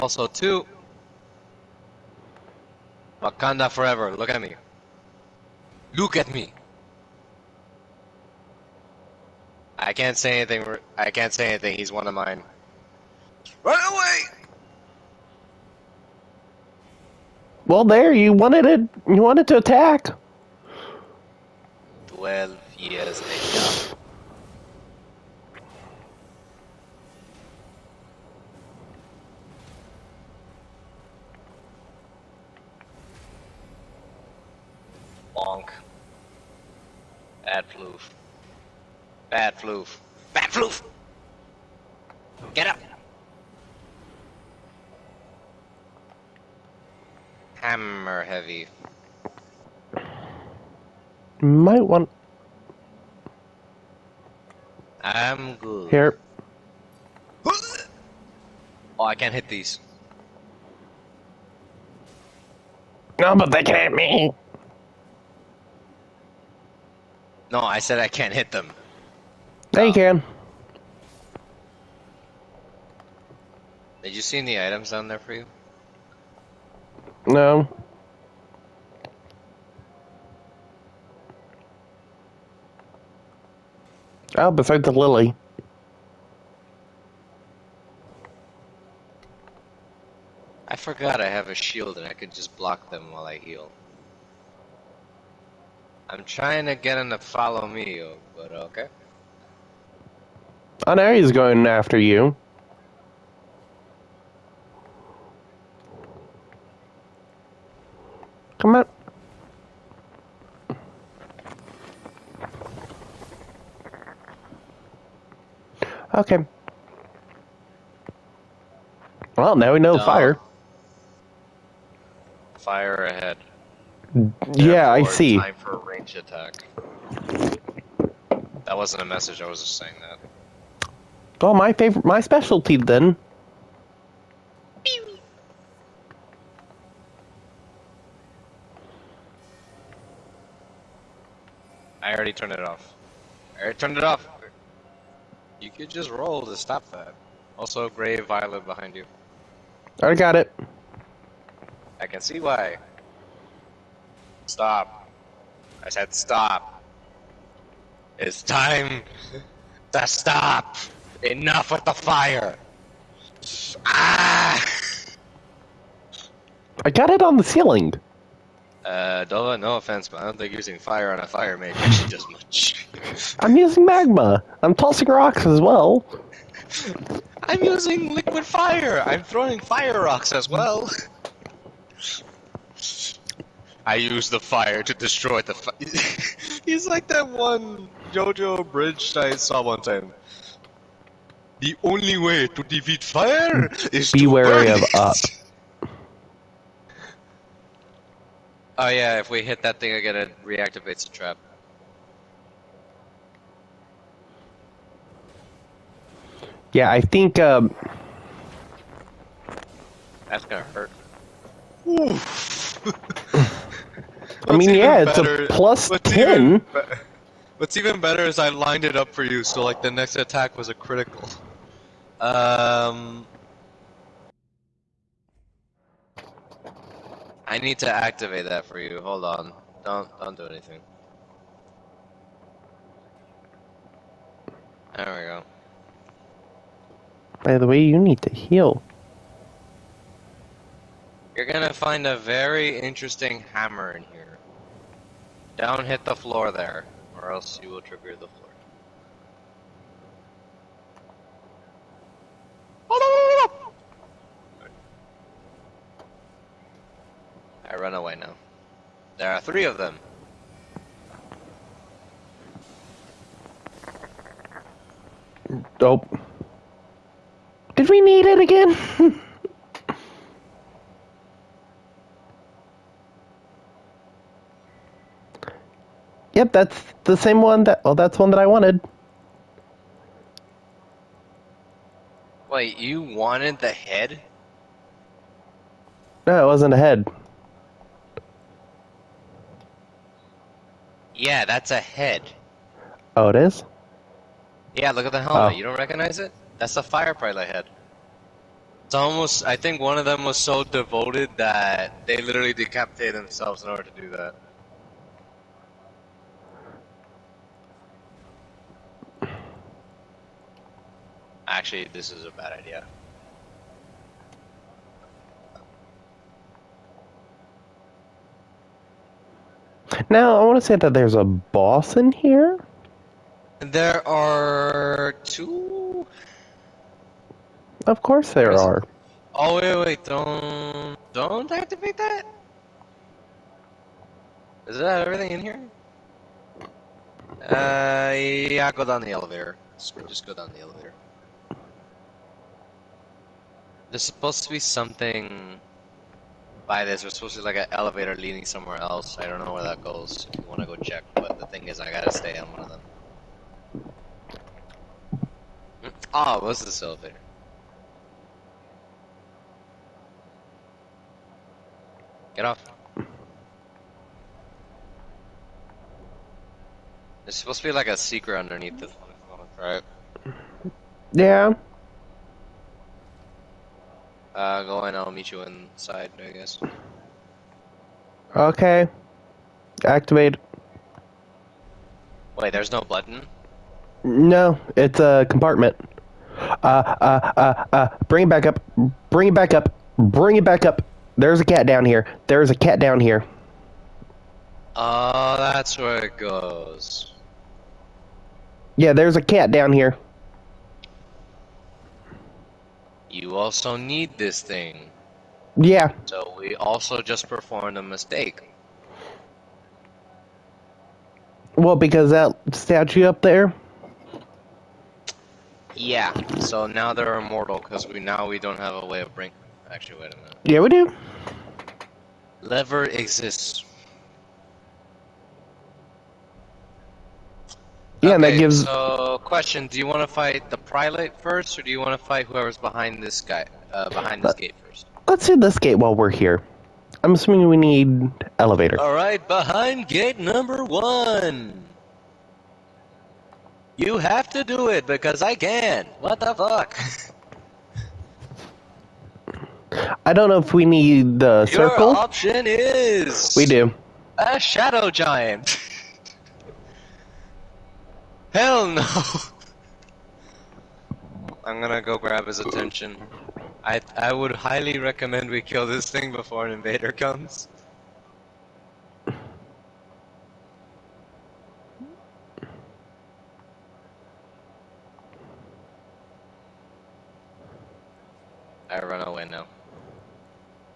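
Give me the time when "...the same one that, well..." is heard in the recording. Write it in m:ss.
4:37.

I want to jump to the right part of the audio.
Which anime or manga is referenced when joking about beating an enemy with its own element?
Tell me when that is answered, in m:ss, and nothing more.
3:08.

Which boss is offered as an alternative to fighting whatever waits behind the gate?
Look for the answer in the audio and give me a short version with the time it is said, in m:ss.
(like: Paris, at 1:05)
The Prelate, at 7:10.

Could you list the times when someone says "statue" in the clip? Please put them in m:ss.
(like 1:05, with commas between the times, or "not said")
6:52.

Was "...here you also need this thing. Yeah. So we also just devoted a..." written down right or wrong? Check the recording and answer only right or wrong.
wrong.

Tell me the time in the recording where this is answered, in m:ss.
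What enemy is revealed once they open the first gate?
7:34.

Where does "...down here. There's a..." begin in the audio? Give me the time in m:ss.
6:31.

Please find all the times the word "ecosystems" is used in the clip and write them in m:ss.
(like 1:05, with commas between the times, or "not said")
not said.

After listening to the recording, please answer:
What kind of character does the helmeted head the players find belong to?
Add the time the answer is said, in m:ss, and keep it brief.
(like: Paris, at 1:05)
fire pilot, at 4:56.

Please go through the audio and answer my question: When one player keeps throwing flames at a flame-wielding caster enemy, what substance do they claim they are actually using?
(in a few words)
Magma.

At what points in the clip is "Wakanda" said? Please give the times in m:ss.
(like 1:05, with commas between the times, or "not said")
0:03.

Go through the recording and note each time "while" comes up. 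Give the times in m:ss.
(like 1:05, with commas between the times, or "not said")
1:33, 7:15.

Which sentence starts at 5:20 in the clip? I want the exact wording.
Now, I want to say that there's a boss in here.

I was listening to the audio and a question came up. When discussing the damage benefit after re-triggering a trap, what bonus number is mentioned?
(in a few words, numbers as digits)
+10.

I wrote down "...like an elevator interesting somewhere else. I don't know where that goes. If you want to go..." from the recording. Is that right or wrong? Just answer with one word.
wrong.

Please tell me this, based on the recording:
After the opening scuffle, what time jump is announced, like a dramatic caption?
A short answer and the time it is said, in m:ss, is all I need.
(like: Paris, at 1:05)
12 years, at 0:22.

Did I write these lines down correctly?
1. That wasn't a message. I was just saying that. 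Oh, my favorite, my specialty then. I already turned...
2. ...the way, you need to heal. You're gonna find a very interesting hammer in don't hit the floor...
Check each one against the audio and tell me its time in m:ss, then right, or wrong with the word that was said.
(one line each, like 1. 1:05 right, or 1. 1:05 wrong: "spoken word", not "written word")
1. 2:08 right
2. 3:57 right.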